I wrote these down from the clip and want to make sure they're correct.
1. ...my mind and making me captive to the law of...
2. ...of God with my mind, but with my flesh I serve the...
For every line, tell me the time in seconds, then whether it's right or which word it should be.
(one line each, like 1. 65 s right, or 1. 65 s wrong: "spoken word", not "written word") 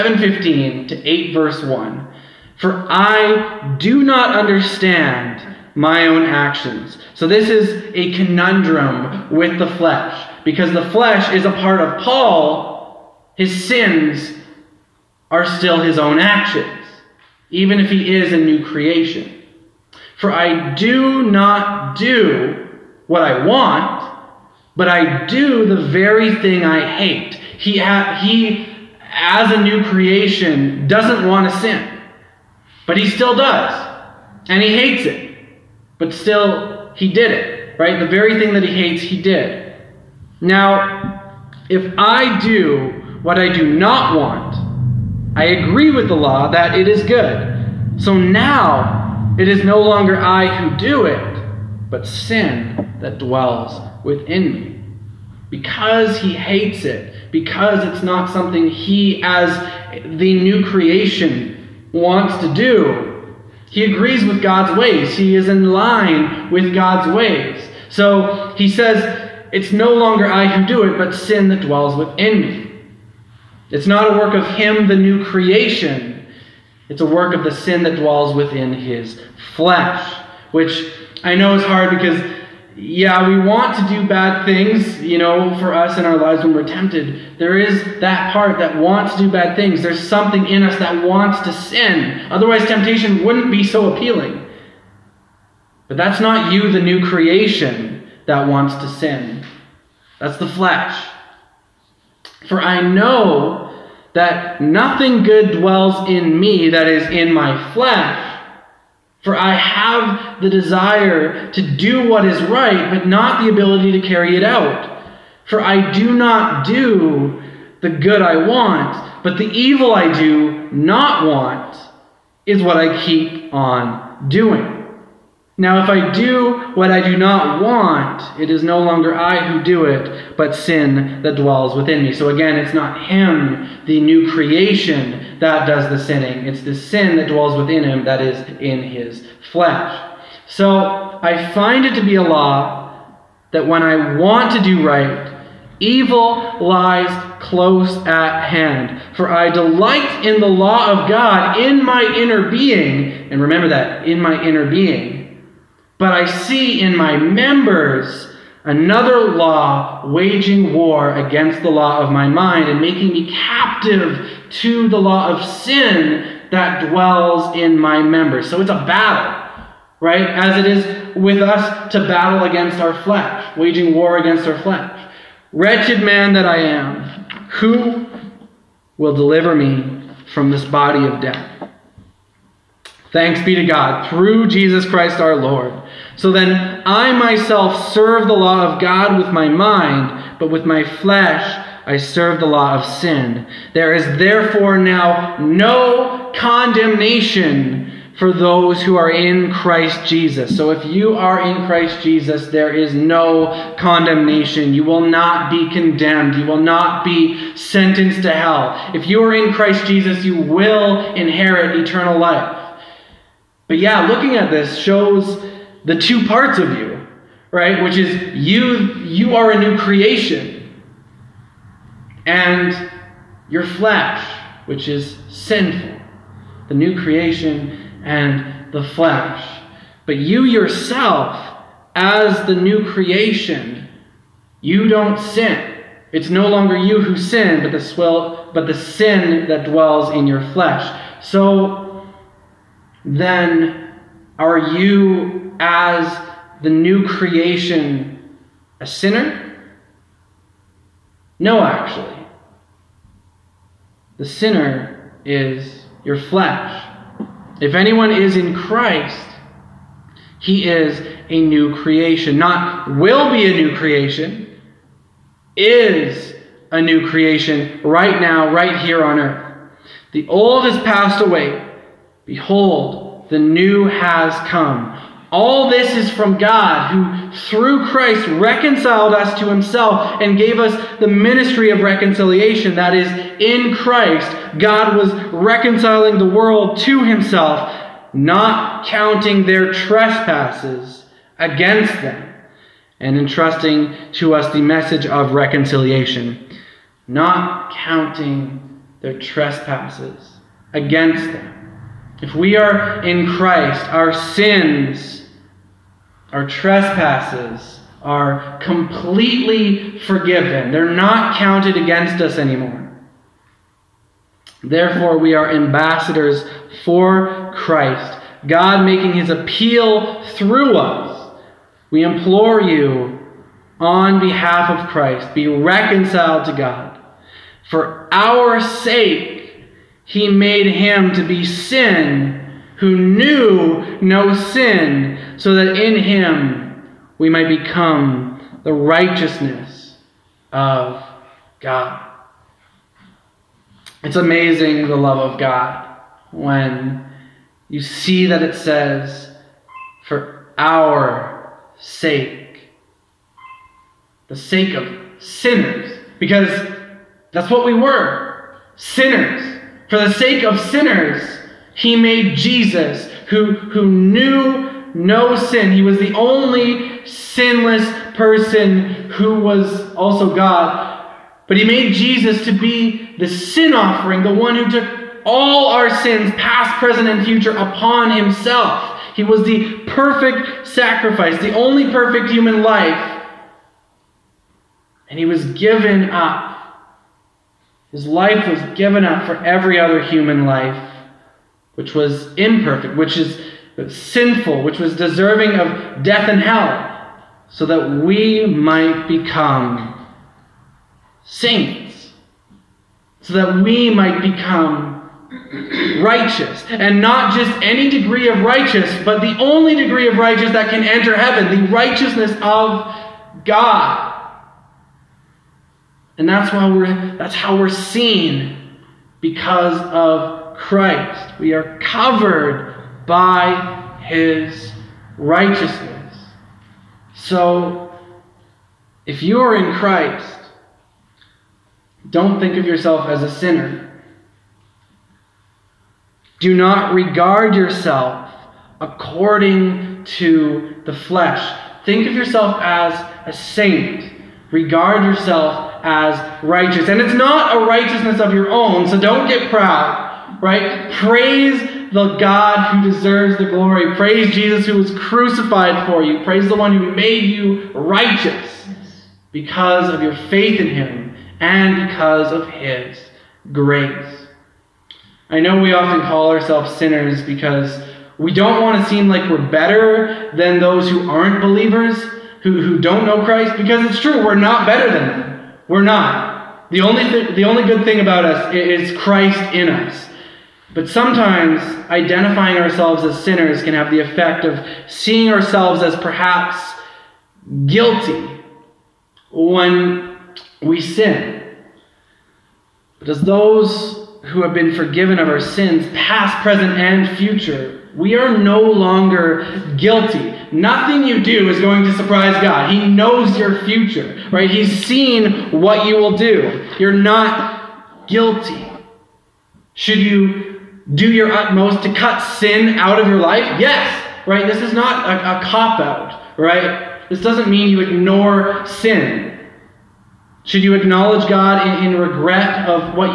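1. 162 s right
2. 188 s right.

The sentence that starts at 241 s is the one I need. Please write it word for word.
So then are you, as the new creation, a sinner?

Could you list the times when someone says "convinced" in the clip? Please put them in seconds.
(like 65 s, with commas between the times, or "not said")
not said.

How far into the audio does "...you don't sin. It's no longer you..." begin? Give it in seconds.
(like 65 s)
234 s.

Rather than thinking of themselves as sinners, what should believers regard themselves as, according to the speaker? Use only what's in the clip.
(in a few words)
a saint.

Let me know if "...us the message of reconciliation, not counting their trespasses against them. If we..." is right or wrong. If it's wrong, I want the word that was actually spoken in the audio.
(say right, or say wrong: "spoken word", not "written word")
right.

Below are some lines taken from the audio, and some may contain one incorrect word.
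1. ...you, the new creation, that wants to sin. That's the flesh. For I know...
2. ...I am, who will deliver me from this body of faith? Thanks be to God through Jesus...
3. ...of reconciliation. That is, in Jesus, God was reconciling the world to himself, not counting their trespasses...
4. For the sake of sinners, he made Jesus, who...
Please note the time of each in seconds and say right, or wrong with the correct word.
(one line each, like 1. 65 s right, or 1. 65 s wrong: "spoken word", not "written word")
1. 96 s right
2. 176 s wrong: "death", not "faith"
3. 281 s wrong: "Christ", not "Jesus"
4. 359 s right.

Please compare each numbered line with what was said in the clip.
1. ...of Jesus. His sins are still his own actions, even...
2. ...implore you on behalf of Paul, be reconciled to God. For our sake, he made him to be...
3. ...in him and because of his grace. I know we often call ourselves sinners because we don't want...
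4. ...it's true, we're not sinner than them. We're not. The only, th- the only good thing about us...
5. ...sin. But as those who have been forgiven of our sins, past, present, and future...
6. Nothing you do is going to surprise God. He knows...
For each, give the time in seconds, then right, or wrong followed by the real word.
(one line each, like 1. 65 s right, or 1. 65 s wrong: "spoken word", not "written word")
1. 11 s wrong: "Paul", not "Jesus"
2. 322 s wrong: "Christ", not "Paul"
3. 460 s right
4. 473 s wrong: "better", not "sinner"
5. 490 s right
6. 500 s right.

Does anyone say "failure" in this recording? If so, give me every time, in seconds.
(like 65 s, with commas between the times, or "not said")
not said.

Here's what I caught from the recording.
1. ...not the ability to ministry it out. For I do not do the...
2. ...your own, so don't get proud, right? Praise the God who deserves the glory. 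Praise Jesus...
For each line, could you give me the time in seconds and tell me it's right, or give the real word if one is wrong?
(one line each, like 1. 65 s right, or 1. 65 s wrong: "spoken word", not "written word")
1. 113 s wrong: "carry", not "ministry"
2. 448 s right.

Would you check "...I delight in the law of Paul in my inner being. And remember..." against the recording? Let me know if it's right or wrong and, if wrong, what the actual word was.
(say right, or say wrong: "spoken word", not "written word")
wrong: "God", not "Paul".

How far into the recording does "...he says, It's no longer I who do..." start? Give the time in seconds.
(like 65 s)
68 s.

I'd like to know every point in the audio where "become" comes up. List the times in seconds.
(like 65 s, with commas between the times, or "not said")
337 s, 399 s, 404 s.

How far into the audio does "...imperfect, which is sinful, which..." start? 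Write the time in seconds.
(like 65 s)
392 s.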